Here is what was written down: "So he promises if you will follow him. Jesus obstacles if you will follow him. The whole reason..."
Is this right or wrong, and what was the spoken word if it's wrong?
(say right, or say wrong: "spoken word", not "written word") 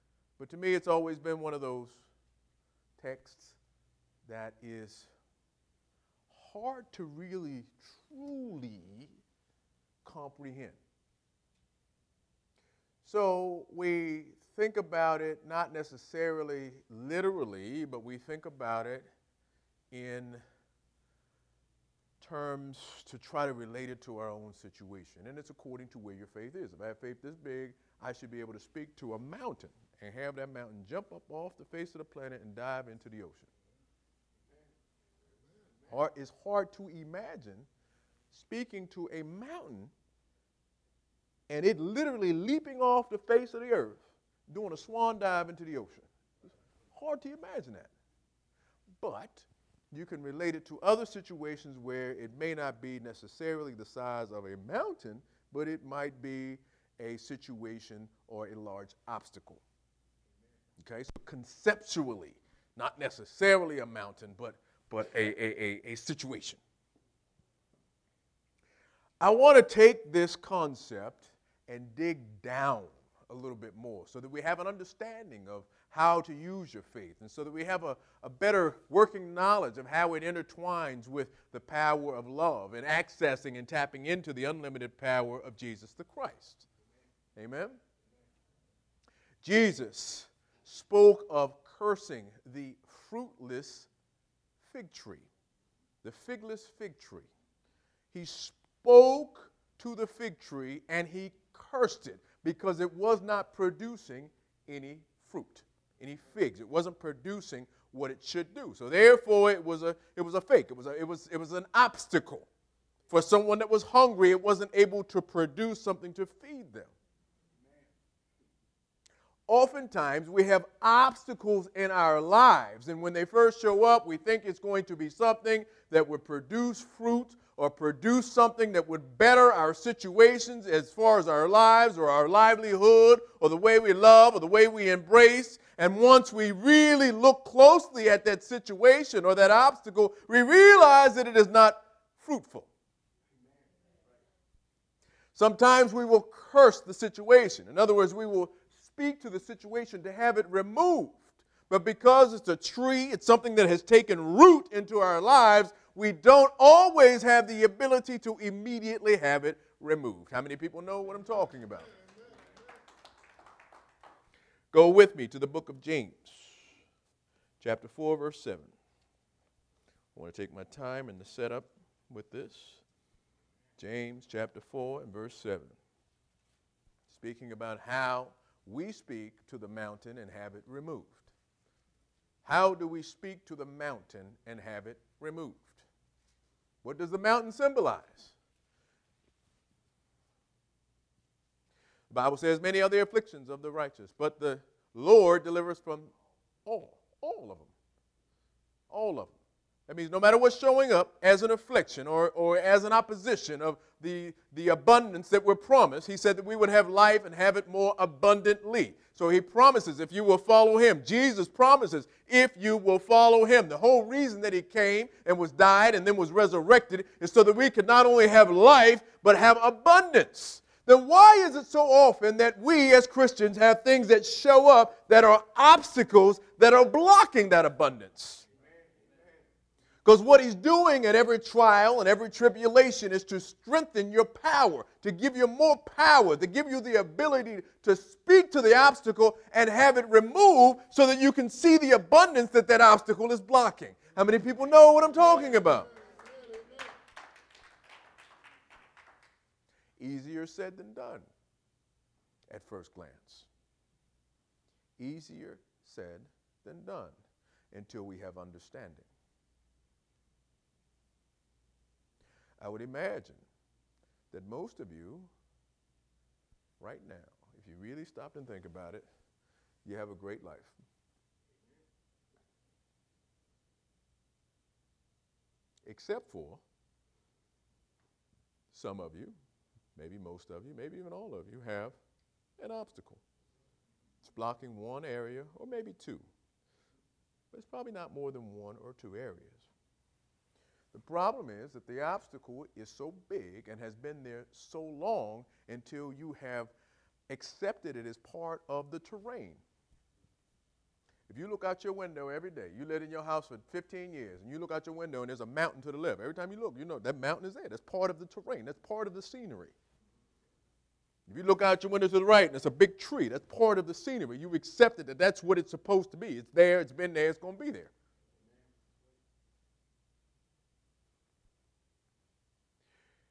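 wrong: "promises", not "obstacles".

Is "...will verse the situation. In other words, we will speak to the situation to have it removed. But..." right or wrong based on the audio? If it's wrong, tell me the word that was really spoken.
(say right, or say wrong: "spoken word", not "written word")
wrong: "curse", not "verse".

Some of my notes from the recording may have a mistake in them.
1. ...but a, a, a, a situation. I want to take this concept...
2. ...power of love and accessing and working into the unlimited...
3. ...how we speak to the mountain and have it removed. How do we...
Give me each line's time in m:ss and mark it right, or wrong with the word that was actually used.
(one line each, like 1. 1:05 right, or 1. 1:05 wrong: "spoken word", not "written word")
1. 1:04 right
2. 1:21 wrong: "tapping", not "working"
3. 2:57 right.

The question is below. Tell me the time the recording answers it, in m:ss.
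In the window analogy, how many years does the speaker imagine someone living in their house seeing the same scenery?
5:03.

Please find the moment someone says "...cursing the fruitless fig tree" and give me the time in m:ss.
1:31.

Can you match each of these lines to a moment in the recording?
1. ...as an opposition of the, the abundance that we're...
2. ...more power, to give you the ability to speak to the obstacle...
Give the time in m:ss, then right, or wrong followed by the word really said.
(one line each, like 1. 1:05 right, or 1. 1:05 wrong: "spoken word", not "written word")
1. 3:22 right
2. 3:55 right.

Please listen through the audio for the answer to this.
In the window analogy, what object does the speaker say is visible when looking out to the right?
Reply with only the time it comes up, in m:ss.
5:12.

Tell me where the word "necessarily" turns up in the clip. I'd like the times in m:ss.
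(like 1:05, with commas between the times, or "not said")
0:15, 0:53, 1:02.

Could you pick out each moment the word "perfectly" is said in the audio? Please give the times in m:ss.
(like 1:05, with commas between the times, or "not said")
not said.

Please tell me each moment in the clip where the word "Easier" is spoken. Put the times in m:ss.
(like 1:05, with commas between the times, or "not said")
4:10, 4:14.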